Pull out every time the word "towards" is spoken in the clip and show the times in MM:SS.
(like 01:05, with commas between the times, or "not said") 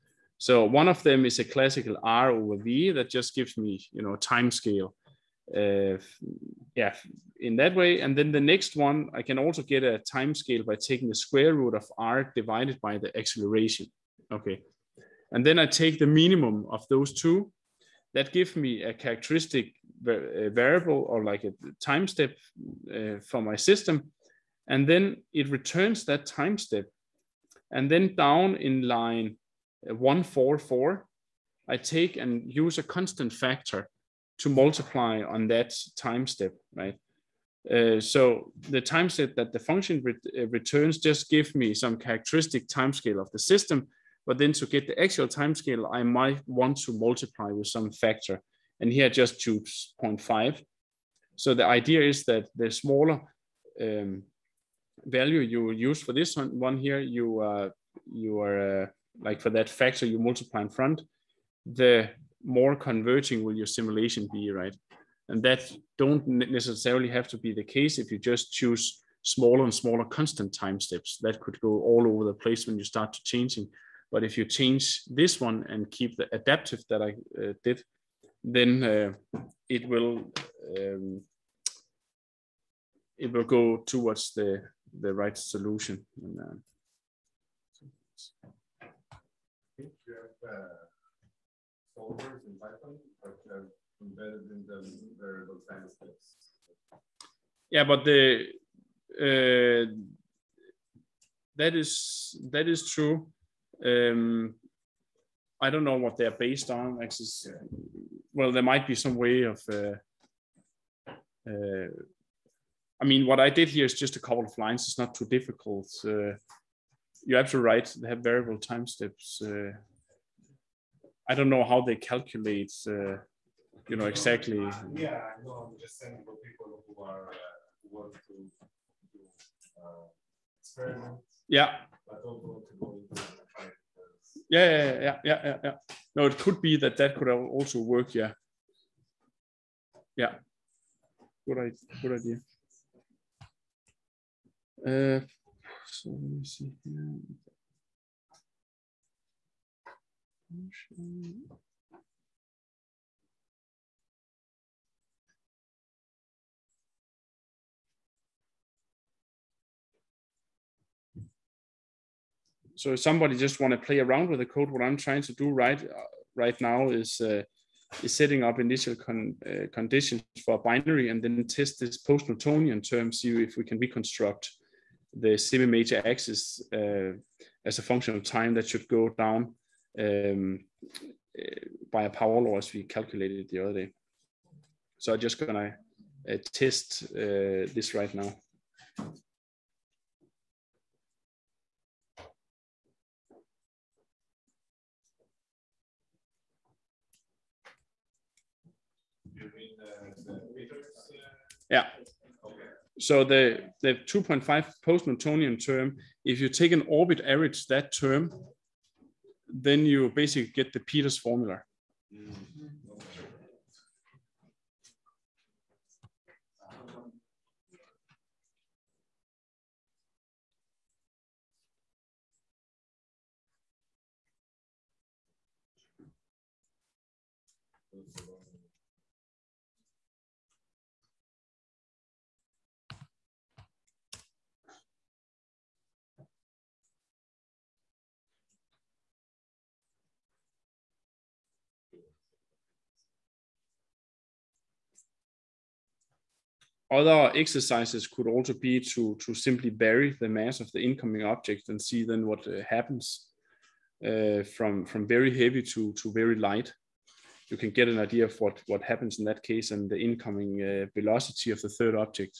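01:23.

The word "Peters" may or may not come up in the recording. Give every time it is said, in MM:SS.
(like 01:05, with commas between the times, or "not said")
03:30.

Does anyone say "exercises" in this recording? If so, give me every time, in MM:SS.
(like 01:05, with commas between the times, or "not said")
04:07.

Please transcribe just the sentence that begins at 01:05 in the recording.
And that don't necessarily have to be the case if you just choose smaller and smaller constant time steps.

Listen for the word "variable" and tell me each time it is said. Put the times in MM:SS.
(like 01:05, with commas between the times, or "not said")
00:20, 01:35, 01:58.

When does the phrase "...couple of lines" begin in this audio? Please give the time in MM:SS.
01:54.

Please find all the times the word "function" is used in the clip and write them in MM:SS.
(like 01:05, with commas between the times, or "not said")
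00:39, 02:57.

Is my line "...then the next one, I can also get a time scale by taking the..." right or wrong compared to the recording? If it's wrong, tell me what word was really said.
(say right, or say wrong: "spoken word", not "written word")
right.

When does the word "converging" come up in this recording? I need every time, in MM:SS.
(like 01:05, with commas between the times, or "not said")
01:02.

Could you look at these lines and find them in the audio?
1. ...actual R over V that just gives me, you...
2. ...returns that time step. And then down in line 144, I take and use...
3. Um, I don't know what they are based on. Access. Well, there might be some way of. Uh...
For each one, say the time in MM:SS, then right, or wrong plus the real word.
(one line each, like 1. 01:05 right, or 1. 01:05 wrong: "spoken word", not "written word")
1. 00:01 wrong: "classical", not "actual"
2. 00:25 right
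3. 01:43 right.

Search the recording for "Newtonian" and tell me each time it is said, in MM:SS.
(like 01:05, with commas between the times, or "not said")
02:51, 03:24.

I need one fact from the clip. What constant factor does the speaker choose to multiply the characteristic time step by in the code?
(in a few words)
0.5.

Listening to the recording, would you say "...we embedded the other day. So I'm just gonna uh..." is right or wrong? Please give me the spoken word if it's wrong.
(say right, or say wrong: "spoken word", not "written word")
wrong: "calculated", not "embedded".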